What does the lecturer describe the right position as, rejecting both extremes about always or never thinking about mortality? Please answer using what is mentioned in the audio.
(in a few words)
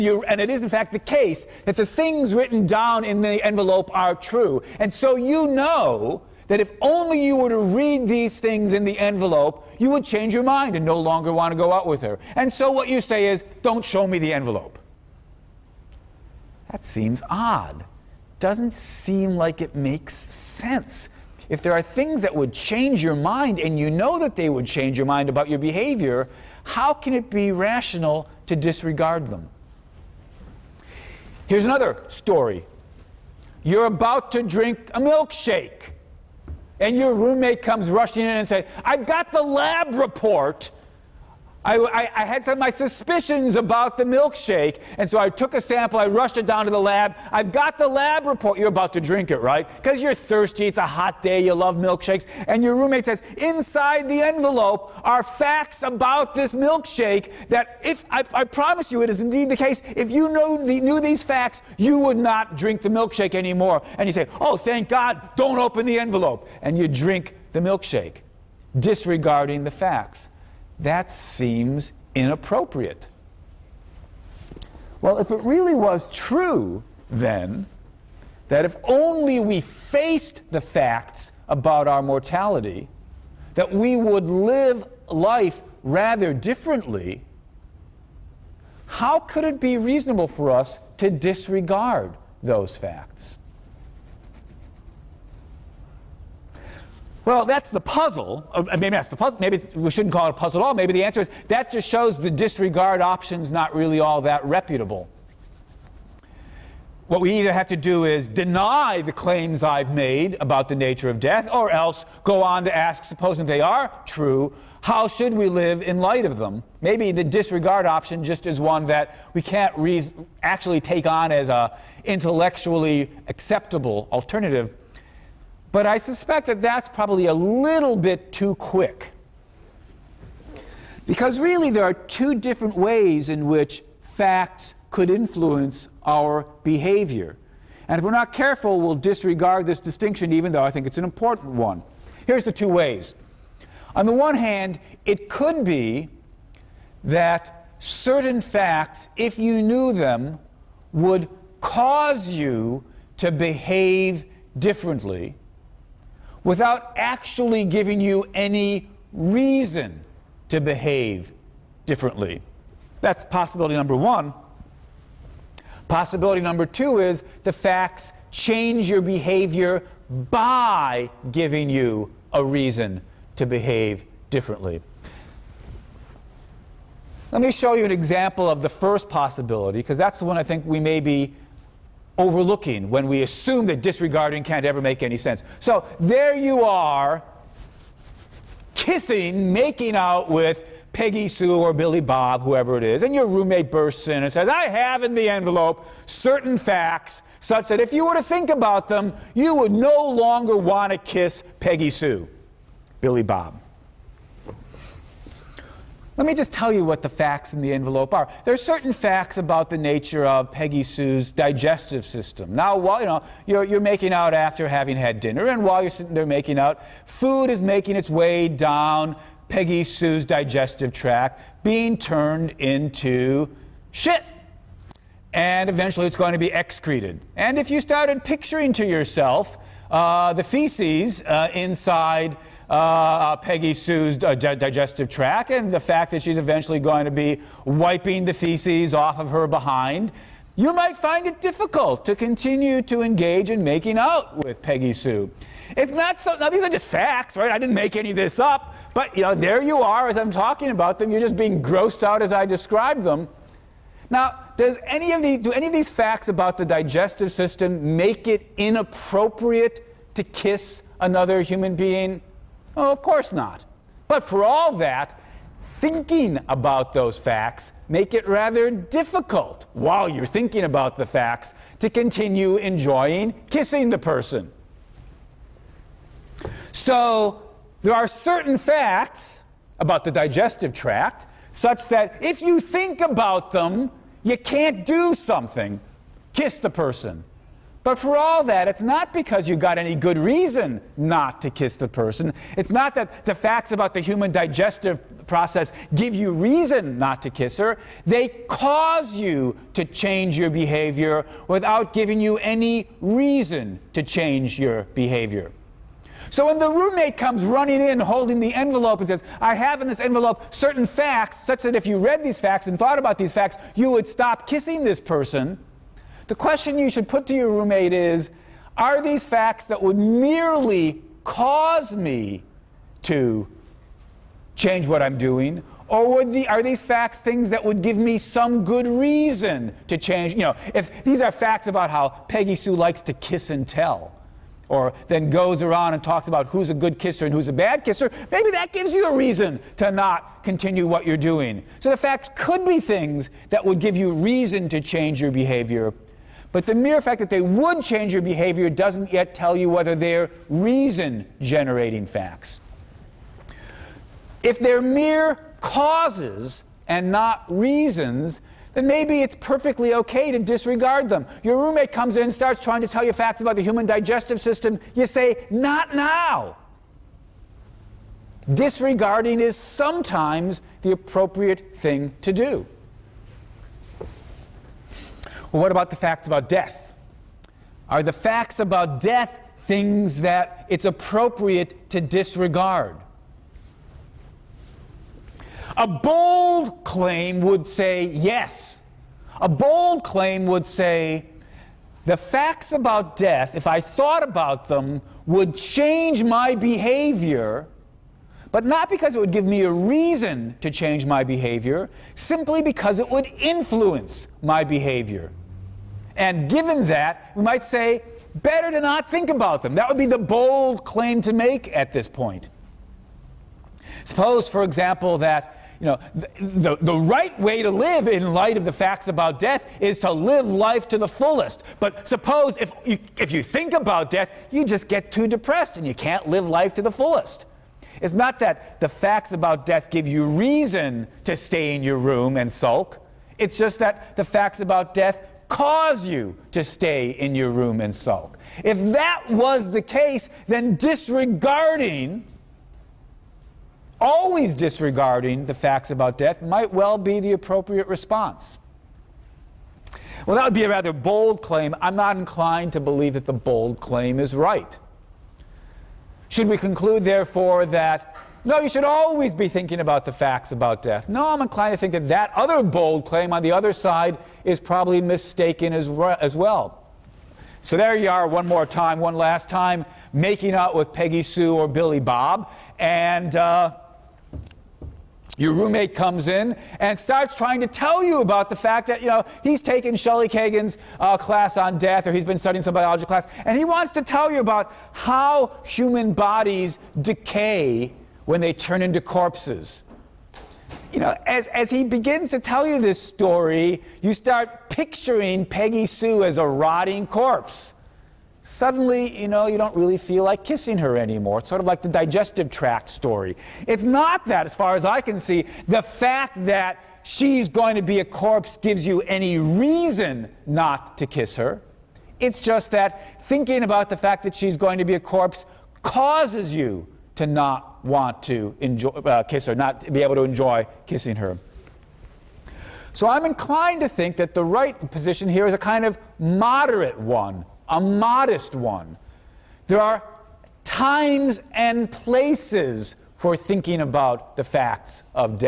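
moderate one.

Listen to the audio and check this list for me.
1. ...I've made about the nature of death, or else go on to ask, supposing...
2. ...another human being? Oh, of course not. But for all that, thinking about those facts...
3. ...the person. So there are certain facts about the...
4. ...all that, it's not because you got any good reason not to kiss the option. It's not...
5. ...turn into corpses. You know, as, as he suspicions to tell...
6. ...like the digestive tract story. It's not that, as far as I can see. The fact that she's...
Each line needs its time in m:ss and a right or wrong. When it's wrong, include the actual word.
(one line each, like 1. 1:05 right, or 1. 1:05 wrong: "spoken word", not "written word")
1. 1:49 right
2. 4:20 right
3. 4:33 right
4. 4:48 wrong: "person", not "option"
5. 8:08 wrong: "begins", not "suspicions"
6. 8:21 right.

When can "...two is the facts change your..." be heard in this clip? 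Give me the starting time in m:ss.
2:46.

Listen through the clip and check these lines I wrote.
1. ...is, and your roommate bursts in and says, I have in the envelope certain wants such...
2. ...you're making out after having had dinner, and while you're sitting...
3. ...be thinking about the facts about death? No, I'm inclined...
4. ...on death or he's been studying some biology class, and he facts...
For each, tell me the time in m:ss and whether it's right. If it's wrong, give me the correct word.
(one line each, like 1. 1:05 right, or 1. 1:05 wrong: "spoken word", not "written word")
1. 3:12 wrong: "facts", not "wants"
2. 3:33 right
3. 7:39 right
4. 8:01 wrong: "wants", not "facts".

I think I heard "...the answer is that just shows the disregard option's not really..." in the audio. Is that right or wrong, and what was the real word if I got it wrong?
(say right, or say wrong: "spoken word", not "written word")
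right.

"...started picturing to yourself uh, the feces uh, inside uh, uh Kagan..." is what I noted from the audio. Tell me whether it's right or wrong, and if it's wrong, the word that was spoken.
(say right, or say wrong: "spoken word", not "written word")
wrong: "Peggy", not "Kagan".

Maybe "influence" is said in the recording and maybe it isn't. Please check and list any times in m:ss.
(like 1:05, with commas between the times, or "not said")
2:15, 6:43.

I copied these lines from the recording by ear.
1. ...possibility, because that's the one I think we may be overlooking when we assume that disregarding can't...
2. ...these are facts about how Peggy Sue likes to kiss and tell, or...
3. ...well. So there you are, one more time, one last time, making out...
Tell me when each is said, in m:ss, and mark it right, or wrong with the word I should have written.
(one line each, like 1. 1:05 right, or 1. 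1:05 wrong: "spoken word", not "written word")
1. 2:59 right
2. 5:31 right
3. 7:46 right.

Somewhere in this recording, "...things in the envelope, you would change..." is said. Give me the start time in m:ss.
0:08.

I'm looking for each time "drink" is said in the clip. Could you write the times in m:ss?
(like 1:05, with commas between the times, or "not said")
0:34, 0:49, 1:02, 1:06.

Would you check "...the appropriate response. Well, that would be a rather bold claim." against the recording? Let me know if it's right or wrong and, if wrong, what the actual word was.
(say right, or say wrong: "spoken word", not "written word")
right.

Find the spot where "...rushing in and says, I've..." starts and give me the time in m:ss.
0:37.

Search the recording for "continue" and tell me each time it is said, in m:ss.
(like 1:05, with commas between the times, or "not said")
4:02, 4:31, 5:40.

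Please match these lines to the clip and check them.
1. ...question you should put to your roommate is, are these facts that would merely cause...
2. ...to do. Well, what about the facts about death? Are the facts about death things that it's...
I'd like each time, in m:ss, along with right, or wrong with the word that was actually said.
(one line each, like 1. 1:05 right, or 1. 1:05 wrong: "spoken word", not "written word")
1. 5:16 right
2. 6:12 right.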